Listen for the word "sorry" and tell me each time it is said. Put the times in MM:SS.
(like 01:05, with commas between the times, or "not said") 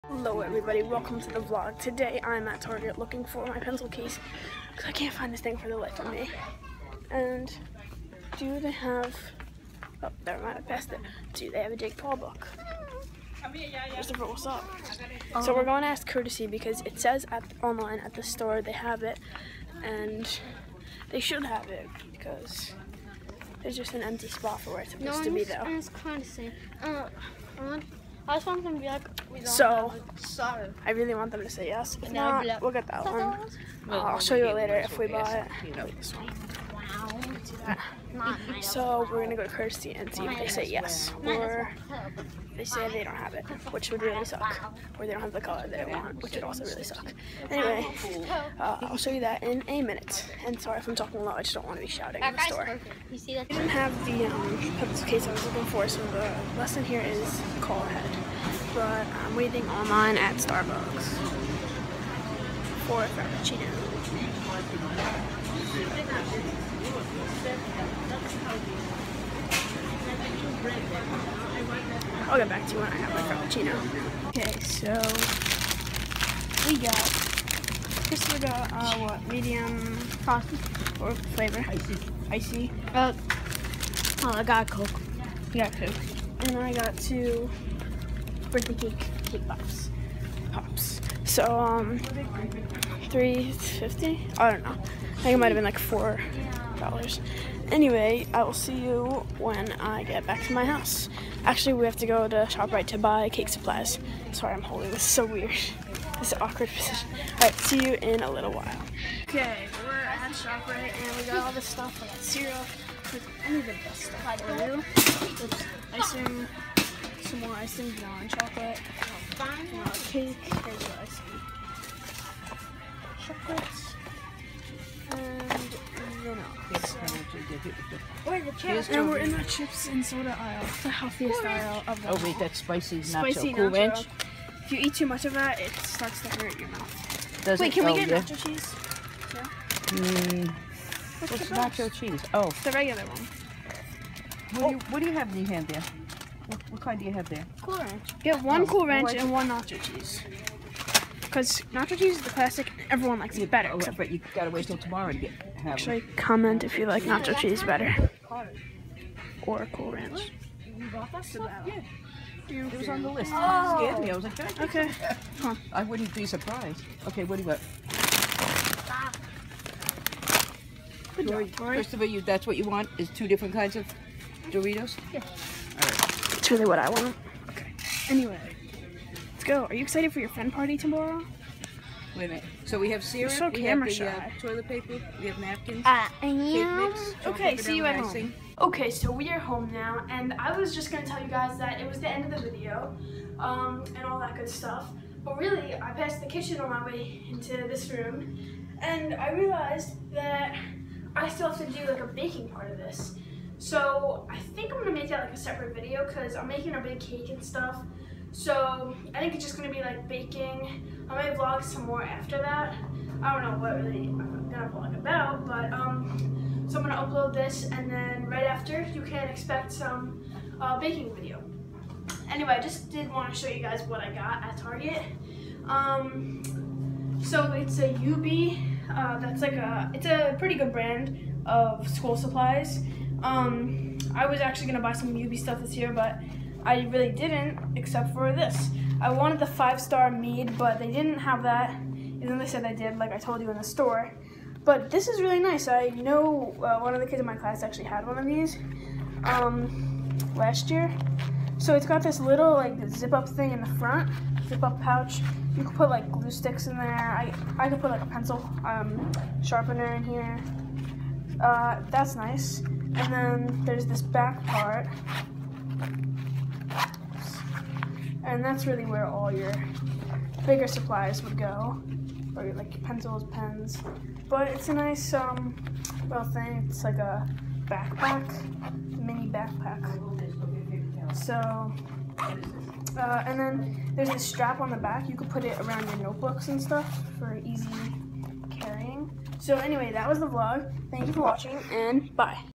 00:50, 01:44.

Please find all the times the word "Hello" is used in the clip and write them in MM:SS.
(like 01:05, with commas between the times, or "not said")
00:00.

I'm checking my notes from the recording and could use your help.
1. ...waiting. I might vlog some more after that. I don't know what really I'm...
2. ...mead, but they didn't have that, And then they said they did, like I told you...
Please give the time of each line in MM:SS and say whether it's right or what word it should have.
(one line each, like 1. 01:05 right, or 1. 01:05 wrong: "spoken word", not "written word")
1. 03:30 wrong: "baking", not "waiting"
2. 04:00 right.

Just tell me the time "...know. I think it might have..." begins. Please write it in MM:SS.
01:34.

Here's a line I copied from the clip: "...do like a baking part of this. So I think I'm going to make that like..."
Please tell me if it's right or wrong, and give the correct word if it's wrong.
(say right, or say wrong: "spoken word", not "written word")
right.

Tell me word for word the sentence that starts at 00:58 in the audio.
But I'm waiting online at Starbucks for a frappuccino.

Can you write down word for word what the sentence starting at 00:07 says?
And do they have, oh, never mind, I passed it.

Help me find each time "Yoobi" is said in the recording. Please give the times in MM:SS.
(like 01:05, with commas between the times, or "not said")
03:47, 03:55.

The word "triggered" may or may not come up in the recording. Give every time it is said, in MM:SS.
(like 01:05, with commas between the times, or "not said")
not said.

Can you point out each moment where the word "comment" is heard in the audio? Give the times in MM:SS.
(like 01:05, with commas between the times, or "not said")
02:36.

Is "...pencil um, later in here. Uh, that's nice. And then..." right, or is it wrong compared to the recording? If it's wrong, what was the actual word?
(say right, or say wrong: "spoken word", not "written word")
wrong: "sharpener", not "later".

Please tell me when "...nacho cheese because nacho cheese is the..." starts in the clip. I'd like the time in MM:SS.
02:29.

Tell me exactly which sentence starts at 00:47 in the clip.
Anyway, uh, I'll show you that in a minute.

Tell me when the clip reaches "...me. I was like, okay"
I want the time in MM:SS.
02:44.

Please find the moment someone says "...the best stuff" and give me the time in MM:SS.
01:53.